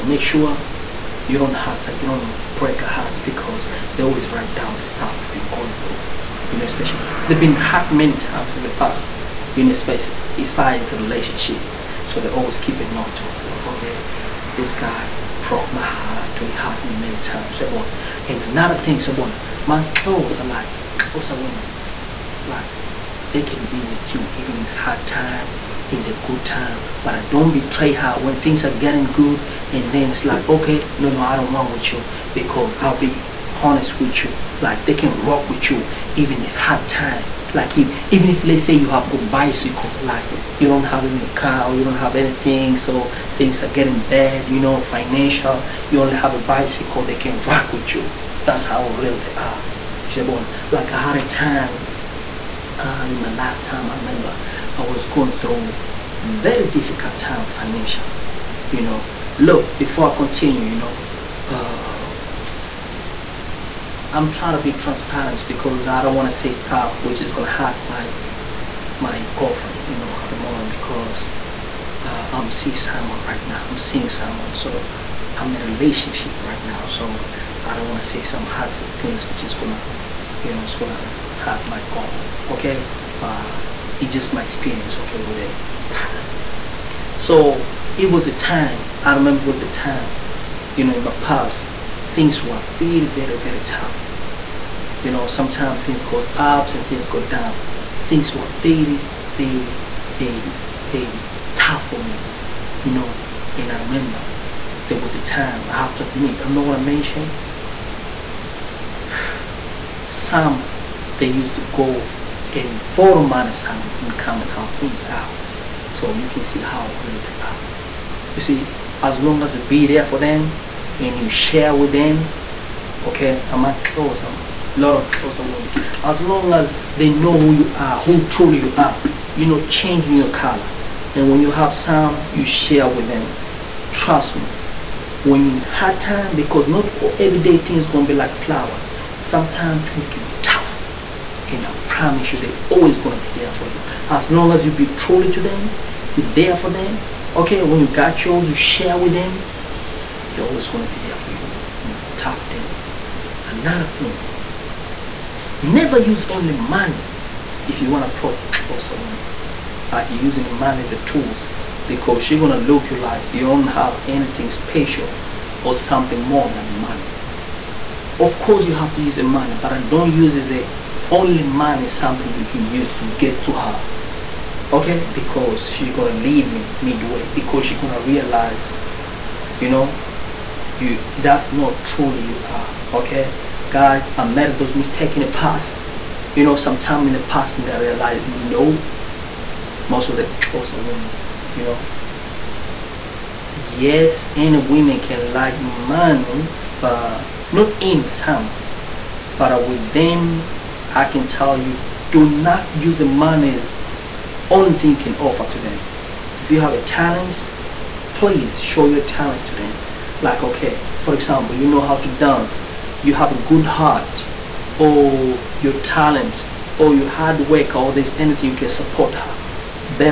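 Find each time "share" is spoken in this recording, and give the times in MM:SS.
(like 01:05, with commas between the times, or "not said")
02:01, 02:12, 02:28.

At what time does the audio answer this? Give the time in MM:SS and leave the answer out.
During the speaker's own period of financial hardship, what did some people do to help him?
01:52.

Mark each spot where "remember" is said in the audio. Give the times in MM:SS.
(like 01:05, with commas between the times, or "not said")
00:53, 01:29, 01:43.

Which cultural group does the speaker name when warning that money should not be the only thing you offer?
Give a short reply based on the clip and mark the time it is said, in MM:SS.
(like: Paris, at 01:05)
Xhosa, at 03:10.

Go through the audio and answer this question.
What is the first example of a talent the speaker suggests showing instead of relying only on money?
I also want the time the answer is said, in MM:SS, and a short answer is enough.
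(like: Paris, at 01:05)
dance, at 03:32.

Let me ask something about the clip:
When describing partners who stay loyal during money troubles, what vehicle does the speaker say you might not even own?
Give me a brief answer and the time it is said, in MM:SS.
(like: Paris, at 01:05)
car, at 00:41.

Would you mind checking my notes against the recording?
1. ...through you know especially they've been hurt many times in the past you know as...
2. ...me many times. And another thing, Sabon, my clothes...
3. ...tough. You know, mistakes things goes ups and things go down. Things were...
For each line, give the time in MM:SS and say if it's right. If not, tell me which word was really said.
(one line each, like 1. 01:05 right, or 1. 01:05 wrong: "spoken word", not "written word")
1. 00:05 right
2. 00:16 right
3. 01:33 wrong: "sometimes", not "mistakes".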